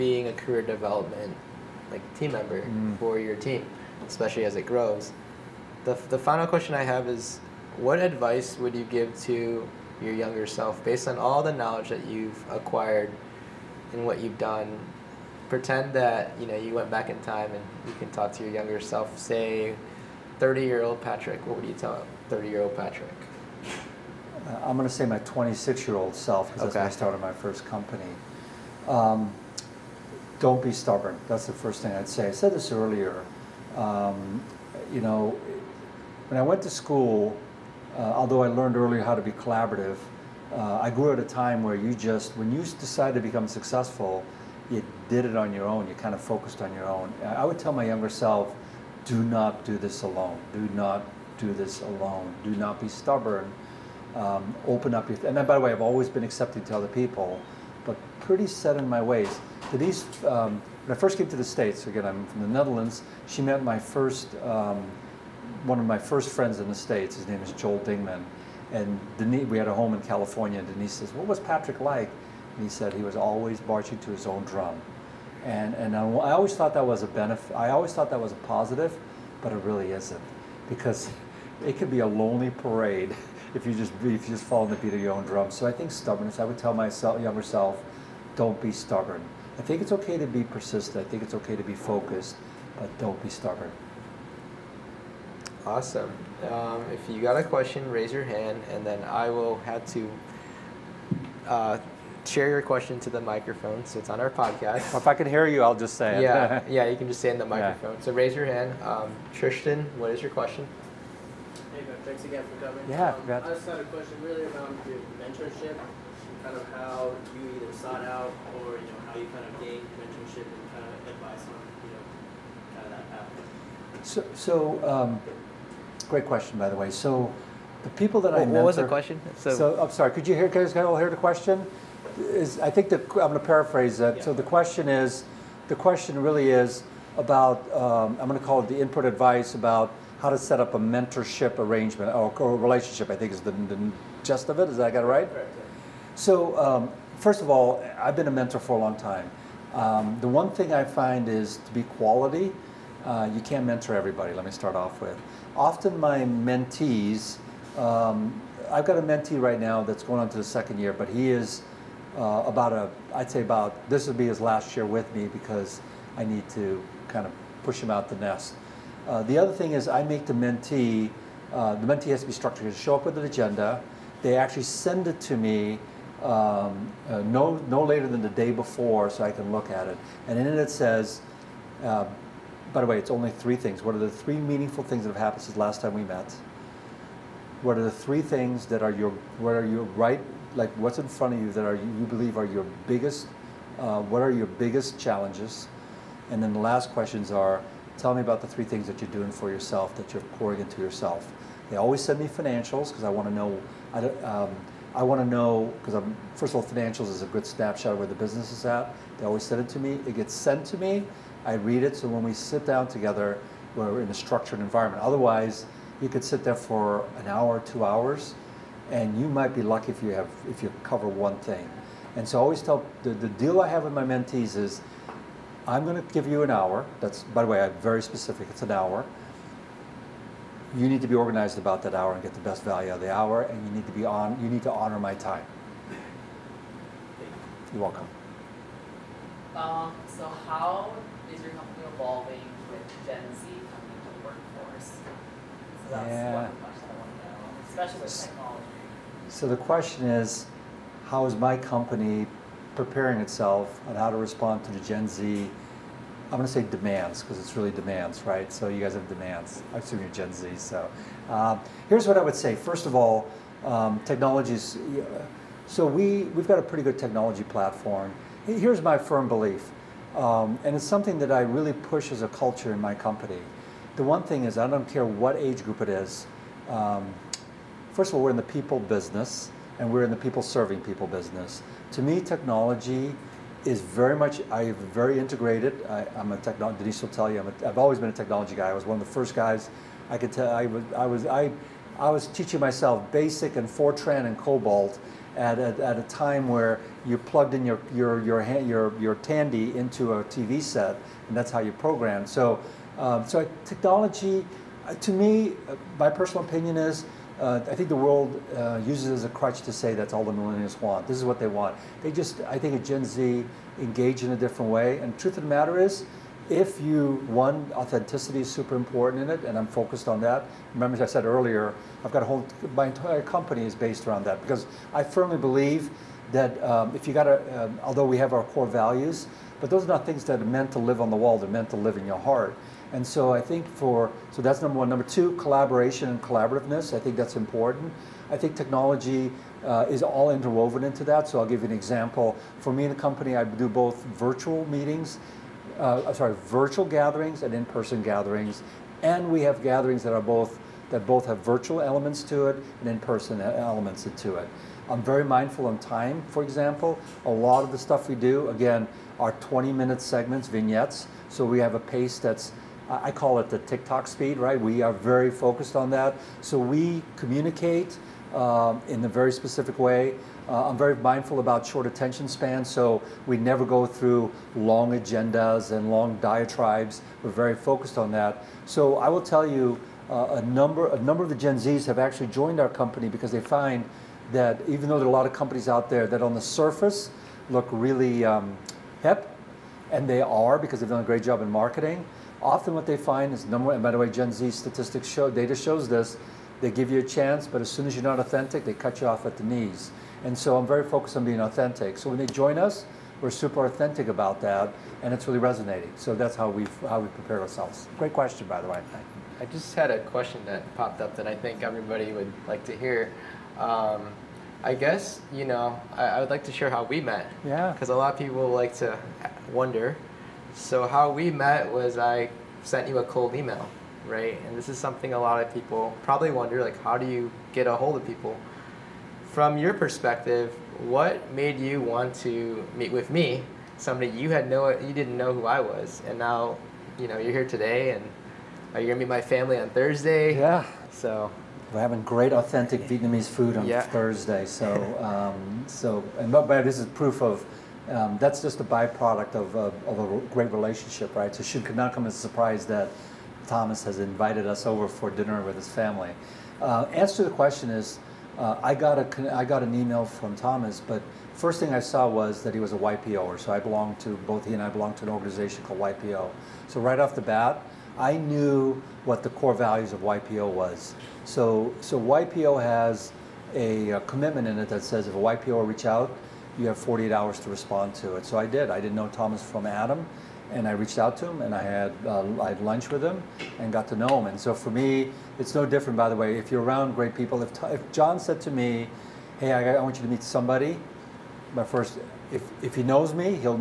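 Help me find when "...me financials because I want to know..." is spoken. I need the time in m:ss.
3:22.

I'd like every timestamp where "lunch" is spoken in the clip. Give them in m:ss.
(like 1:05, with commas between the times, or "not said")
8:02.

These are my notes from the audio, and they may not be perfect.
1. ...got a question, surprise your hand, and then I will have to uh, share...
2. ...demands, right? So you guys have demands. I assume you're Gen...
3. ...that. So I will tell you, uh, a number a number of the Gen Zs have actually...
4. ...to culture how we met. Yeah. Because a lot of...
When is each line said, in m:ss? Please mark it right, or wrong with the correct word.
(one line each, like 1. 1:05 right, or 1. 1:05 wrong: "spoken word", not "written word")
1. 1:37 wrong: "raise", not "surprise"
2. 4:17 right
3. 6:18 right
4. 6:56 wrong: "share", not "culture".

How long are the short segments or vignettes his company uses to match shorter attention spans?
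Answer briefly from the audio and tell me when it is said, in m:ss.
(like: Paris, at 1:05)
20 minutes, at 5:59.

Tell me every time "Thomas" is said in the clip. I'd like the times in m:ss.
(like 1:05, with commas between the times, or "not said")
7:33, 7:40, 7:59.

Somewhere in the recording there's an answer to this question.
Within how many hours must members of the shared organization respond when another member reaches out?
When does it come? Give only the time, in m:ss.
7:56.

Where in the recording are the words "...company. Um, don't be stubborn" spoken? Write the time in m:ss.
0:27.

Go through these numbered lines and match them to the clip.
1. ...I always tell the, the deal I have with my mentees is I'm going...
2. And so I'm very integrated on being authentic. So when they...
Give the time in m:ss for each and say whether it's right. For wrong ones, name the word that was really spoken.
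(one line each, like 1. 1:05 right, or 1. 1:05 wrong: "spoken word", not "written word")
1. 3:42 right
2. 6:40 wrong: "focused", not "integrated".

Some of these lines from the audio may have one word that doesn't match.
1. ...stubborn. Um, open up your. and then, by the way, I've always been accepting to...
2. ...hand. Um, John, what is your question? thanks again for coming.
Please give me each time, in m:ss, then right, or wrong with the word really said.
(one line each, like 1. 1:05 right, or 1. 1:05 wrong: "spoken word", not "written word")
1. 0:52 right
2. 1:48 wrong: "Tristan", not "John".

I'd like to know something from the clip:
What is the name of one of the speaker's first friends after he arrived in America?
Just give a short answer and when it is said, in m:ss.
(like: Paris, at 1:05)
Joel Dingman, at 1:07.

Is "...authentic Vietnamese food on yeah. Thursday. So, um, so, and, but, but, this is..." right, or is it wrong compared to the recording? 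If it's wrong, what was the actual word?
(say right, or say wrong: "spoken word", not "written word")
right.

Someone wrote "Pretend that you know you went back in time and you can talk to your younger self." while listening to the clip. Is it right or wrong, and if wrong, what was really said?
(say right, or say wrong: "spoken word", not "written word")
right.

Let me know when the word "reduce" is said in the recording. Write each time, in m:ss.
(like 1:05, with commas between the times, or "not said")
not said.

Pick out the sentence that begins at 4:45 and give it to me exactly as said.
I, am a technology, Denise will tell you, i have always been a technology guy.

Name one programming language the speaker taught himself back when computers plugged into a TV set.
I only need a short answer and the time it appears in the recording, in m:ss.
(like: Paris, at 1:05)
Fortran, at 4:53.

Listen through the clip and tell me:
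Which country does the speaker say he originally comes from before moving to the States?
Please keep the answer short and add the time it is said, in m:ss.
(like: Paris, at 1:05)
the Netherlands, at 1:02.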